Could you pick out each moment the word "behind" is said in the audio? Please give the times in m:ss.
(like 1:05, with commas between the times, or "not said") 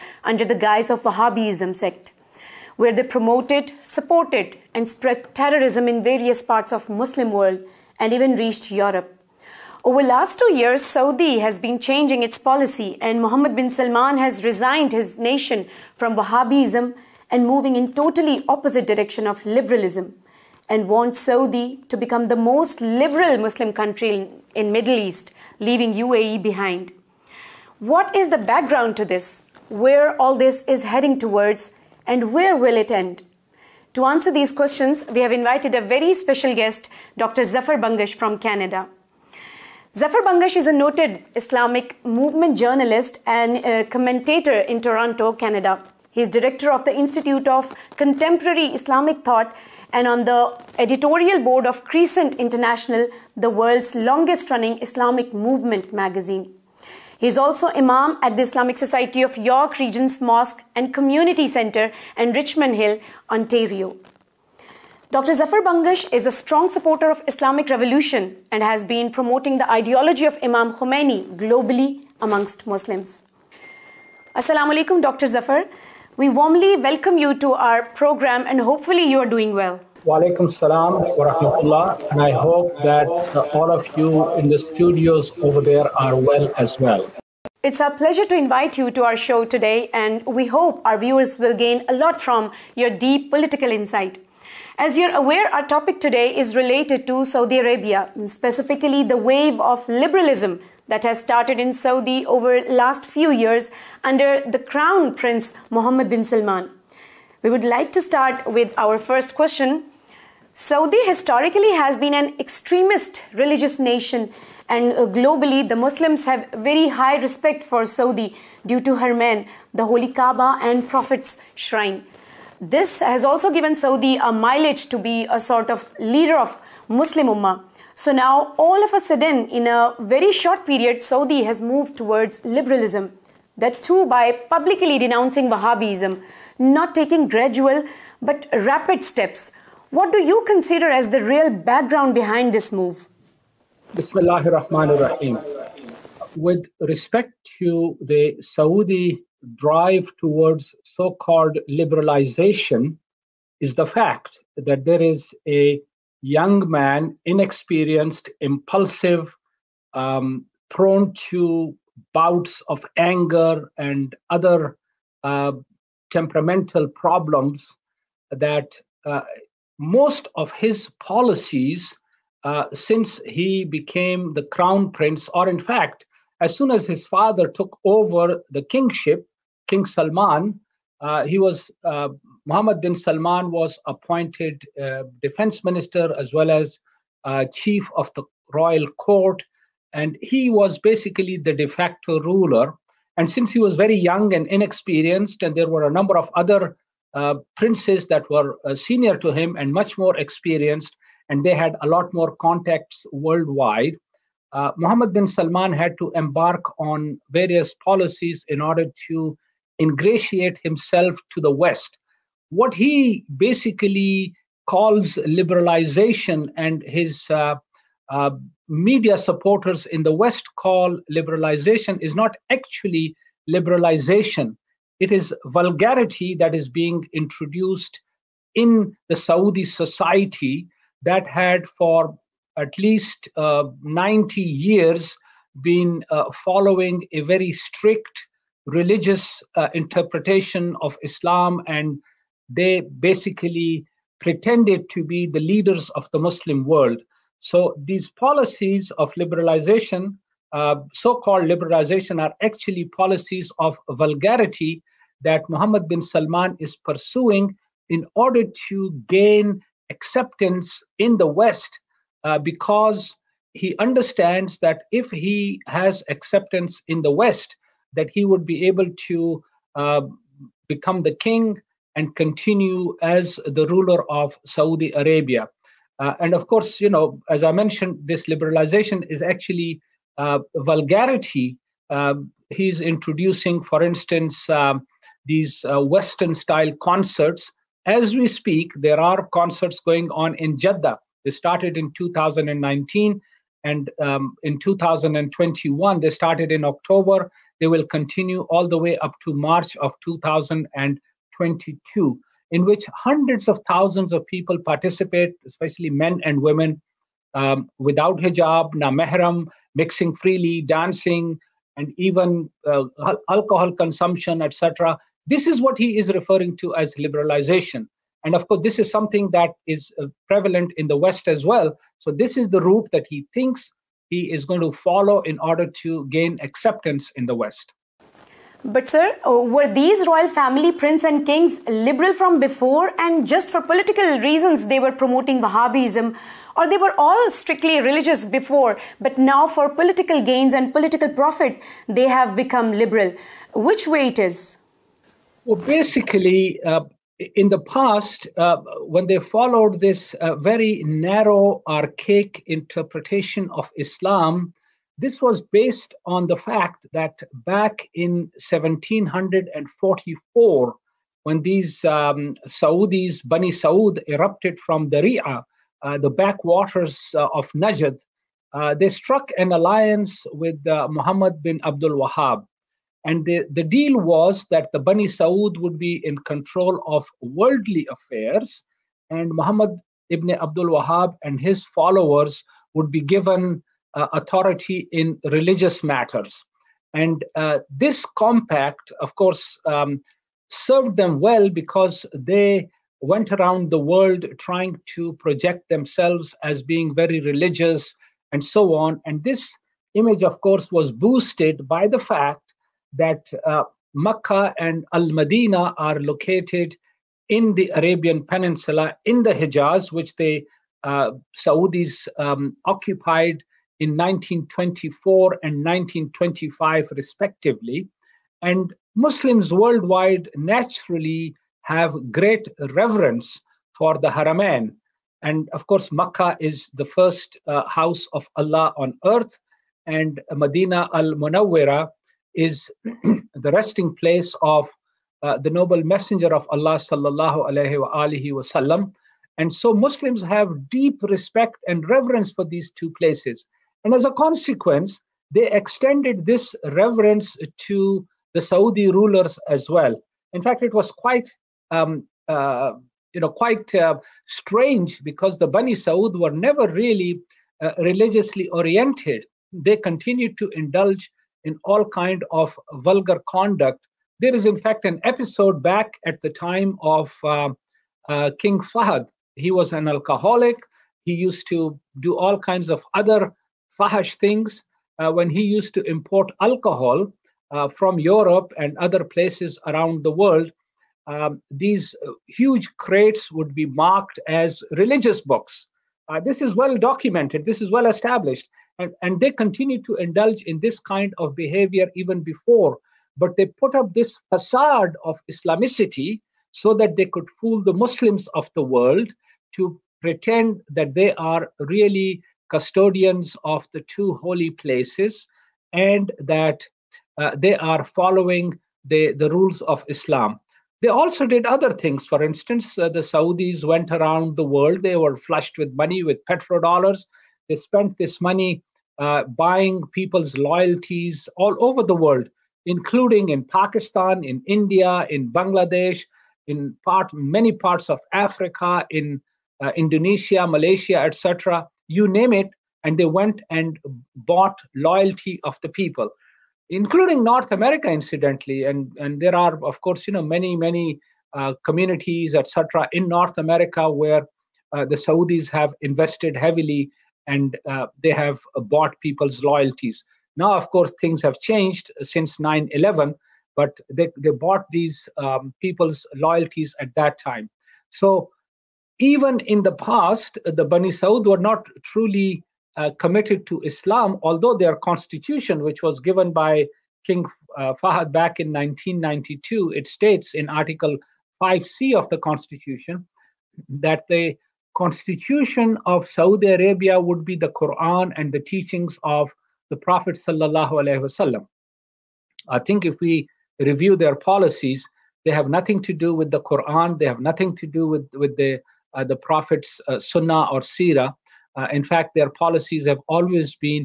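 0:26, 2:22.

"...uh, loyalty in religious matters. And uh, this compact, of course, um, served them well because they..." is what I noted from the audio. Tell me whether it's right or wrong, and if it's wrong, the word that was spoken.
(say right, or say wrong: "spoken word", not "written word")
wrong: "authority", not "loyalty".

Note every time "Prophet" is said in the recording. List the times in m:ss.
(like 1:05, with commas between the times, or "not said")
2:00, 9:39, 9:49.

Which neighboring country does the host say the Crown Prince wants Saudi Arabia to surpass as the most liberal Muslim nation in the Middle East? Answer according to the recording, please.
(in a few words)
UAE.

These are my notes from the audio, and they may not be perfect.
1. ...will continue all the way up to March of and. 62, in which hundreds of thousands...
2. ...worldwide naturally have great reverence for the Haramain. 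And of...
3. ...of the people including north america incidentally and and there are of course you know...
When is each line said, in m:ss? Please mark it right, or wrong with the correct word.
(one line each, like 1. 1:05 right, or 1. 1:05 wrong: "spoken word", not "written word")
1. 4:57 wrong: "22", not "62"
2. 6:59 right
3. 8:55 right.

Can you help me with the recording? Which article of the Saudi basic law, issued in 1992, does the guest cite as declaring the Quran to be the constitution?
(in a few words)
Article 5C.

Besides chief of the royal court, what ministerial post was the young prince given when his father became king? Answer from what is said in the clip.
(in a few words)
Defense minister.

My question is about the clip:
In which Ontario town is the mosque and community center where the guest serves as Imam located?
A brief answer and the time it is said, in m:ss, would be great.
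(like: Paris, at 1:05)
Richmond Hill, at 1:02.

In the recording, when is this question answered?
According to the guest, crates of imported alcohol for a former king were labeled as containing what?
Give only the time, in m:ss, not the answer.
8:04.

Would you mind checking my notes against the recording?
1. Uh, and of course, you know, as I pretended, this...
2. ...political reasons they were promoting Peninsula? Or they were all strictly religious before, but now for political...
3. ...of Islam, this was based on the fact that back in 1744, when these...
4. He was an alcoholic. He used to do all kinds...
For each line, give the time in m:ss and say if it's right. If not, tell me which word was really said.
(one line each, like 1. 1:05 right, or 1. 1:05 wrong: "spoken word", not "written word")
1. 4:35 wrong: "mentioned", not "pretended"
2. 5:33 wrong: "Wahhabism", not "Peninsula"
3. 5:53 right
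4. 7:49 right.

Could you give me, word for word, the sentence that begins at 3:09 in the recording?
And he was basically the de facto ruler.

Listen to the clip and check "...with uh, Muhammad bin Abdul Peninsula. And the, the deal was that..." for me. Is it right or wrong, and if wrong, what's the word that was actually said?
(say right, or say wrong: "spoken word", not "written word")
wrong: "Wahhab", not "Peninsula".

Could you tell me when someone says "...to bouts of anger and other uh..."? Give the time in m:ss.
2:41.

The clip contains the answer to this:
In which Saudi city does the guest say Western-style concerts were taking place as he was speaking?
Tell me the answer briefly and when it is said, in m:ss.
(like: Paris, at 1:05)
Jeddah, at 4:50.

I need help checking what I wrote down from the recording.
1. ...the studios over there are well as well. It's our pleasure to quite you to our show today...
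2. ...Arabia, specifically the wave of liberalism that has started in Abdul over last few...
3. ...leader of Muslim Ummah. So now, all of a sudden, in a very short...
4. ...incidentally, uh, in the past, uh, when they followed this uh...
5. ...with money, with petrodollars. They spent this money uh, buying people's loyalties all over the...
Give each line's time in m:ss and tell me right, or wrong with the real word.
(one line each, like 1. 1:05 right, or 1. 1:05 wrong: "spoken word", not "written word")
1. 1:24 wrong: "invite", not "quite"
2. 1:37 wrong: "Saudi", not "Abdul"
3. 2:05 right
4. 5:45 wrong: "basically", not "incidentally"
5. 8:35 right.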